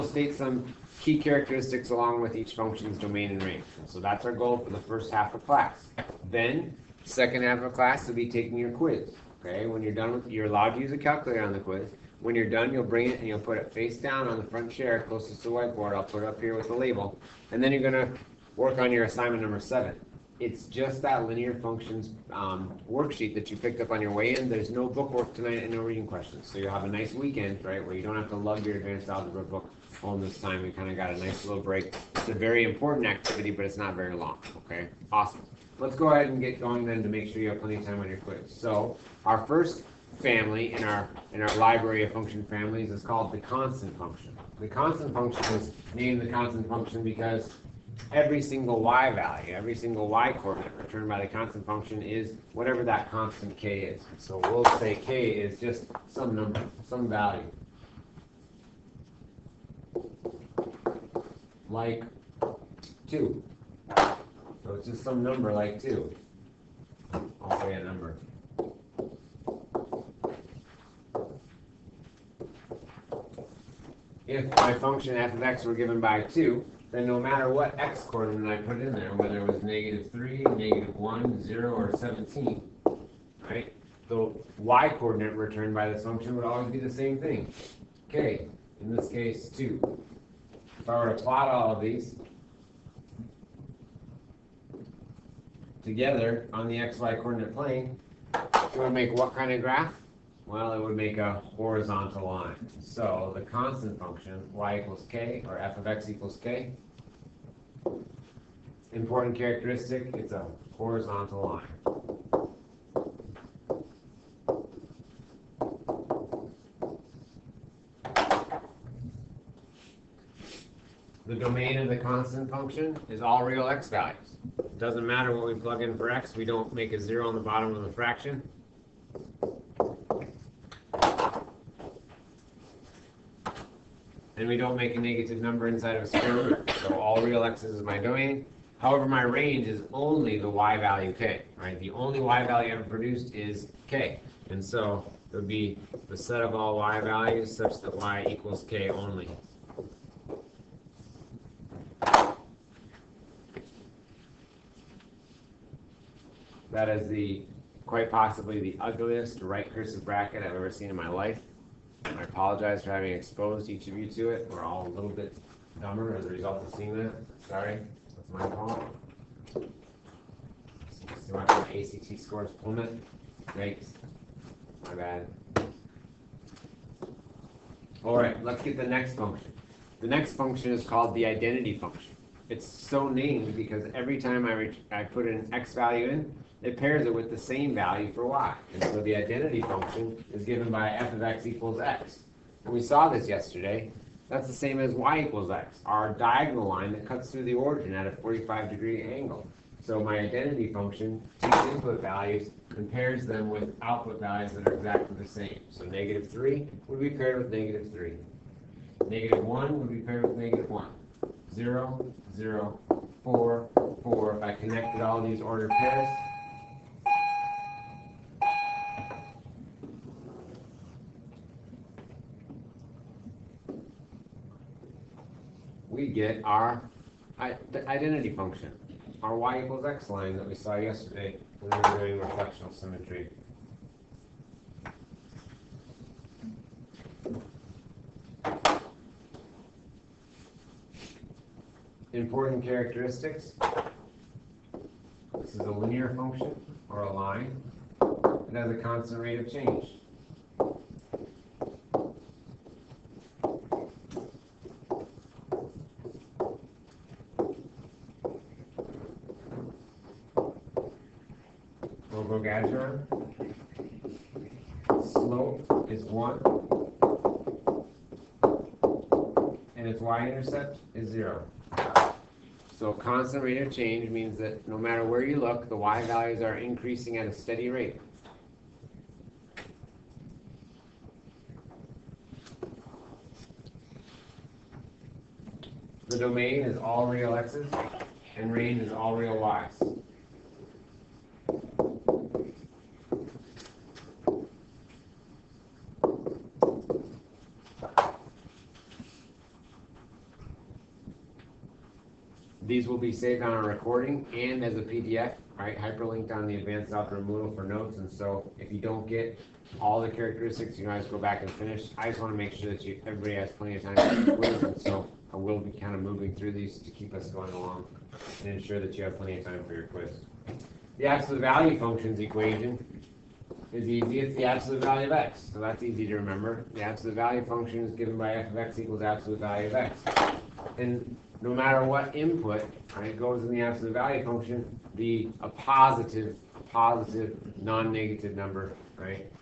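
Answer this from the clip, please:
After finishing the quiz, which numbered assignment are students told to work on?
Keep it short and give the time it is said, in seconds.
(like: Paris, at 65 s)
7, at 19 s.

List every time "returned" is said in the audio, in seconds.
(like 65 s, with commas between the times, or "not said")
50 s, 85 s.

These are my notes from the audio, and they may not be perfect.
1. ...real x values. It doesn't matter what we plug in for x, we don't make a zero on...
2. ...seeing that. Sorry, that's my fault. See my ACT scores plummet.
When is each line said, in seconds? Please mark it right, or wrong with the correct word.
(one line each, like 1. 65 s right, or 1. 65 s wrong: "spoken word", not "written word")
1. 123 s right
2. 166 s right.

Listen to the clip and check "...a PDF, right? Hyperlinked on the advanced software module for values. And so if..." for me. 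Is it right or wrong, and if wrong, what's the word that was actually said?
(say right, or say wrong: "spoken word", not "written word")
wrong: "notes", not "values".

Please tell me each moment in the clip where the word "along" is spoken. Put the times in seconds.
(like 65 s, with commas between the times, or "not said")
1 s, 317 s.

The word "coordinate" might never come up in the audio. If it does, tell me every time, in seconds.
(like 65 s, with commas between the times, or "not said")
50 s, 78 s, 84 s, 97 s.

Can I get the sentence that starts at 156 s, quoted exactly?
That is the quite possibly the ugliest right cursive bracket I've ever seen in my life.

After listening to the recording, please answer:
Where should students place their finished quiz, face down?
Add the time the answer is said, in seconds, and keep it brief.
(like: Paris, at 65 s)
Front chair closest to the whiteboard, at 14 s.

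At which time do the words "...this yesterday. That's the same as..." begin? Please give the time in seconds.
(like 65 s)
193 s.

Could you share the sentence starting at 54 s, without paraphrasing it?
So we'll say k is just some number, some value.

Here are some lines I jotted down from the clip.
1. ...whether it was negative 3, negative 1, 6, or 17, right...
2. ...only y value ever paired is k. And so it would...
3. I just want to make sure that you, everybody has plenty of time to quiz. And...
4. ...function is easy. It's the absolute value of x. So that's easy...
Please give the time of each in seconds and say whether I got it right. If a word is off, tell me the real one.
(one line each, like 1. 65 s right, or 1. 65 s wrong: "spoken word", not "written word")
1. 79 s wrong: "0", not "6"
2. 141 s wrong: "produced", not "paired"
3. 311 s right
4. 322 s wrong: "equation", not "function".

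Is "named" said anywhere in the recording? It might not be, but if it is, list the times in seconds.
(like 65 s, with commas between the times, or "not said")
45 s, 183 s.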